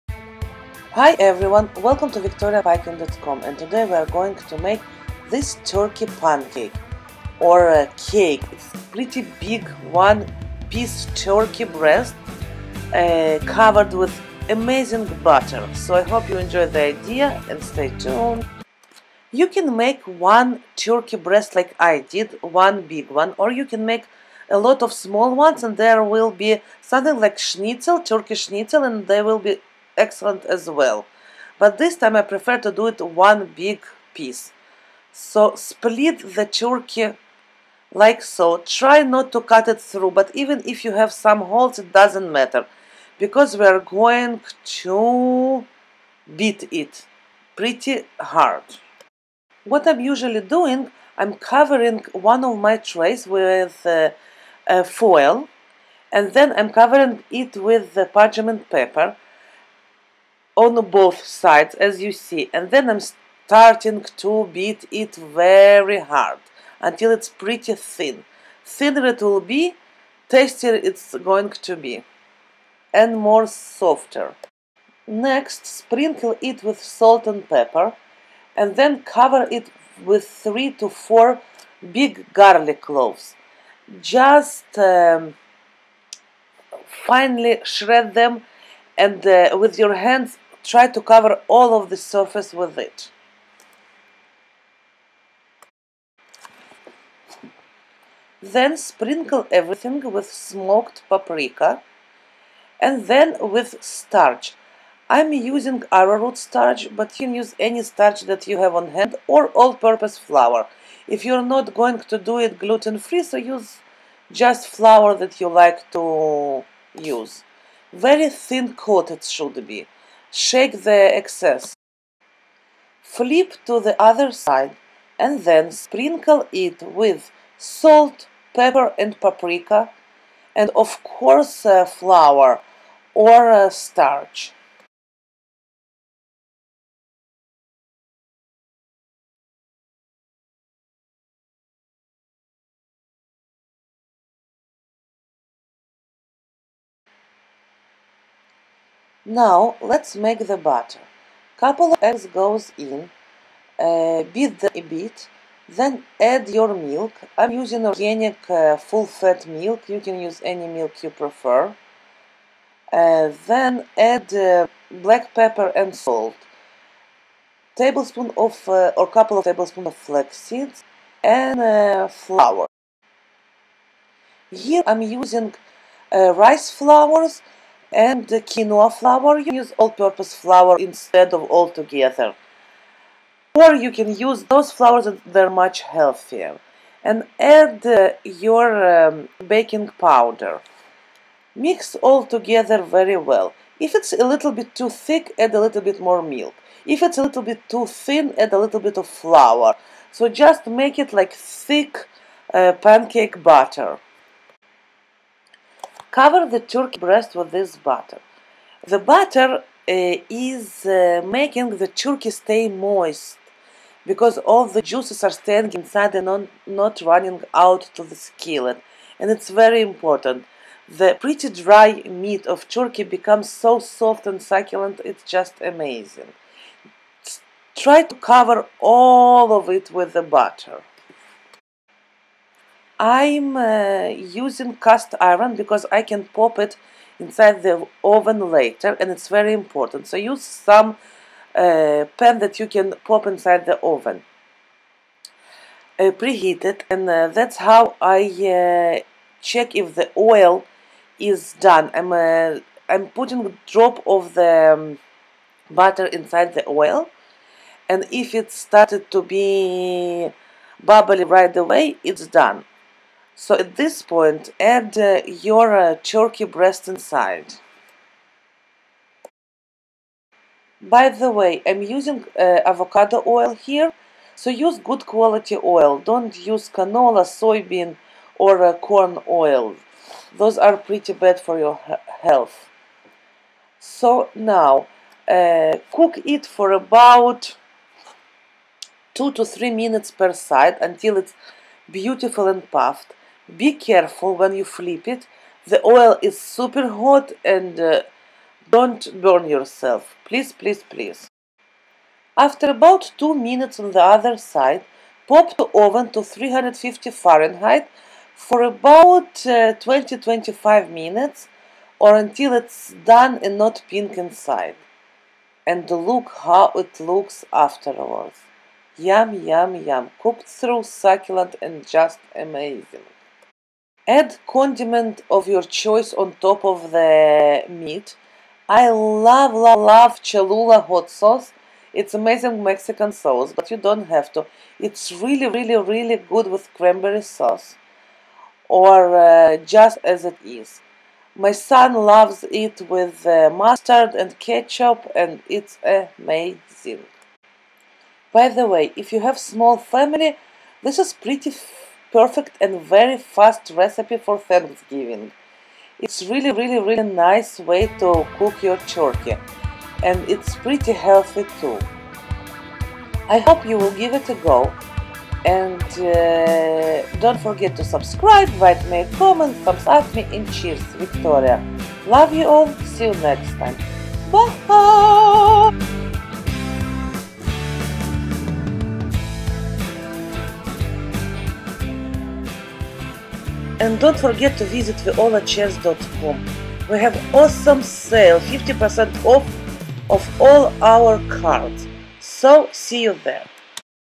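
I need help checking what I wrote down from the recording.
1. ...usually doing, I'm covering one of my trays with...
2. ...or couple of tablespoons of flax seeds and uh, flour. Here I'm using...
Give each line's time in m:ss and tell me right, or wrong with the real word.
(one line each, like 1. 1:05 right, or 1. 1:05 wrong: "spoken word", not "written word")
1. 0:50 right
2. 2:48 right.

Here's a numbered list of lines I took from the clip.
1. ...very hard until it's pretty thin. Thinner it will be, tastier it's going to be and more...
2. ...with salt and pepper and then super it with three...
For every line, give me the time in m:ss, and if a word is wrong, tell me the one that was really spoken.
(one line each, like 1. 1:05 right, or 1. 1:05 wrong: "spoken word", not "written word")
1. 1:05 right
2. 1:16 wrong: "cover", not "super".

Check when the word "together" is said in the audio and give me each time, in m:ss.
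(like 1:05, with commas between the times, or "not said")
3:01, 3:12.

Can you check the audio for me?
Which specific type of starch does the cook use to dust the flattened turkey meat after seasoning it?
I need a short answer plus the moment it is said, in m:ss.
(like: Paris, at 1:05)
Arrowroot starch, at 1:45.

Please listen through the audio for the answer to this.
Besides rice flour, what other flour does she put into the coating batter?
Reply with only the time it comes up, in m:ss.
2:58.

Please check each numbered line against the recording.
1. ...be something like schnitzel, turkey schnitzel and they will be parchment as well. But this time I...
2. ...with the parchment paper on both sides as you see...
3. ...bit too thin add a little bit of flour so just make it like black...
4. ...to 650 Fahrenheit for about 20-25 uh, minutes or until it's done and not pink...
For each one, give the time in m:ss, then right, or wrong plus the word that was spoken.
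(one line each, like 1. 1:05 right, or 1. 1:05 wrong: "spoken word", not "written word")
1. 0:26 wrong: "excellent", not "parchment"
2. 0:57 right
3. 3:17 wrong: "thick", not "black"
4. 5:06 wrong: "350", not "650".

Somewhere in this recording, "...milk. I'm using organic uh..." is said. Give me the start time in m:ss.
2:36.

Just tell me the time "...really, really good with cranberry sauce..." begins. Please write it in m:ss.
5:35.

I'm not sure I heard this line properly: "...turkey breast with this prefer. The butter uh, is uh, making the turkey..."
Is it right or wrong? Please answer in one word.
wrong.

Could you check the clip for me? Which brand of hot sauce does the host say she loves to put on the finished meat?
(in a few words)
Cholula.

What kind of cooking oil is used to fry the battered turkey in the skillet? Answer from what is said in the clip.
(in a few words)
Avocado oil.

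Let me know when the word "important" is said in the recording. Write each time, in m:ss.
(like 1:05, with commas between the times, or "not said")
3:39, 3:59.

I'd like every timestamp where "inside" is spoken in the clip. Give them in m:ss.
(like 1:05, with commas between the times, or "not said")
3:35, 3:57, 4:03, 4:16, 4:26, 5:14.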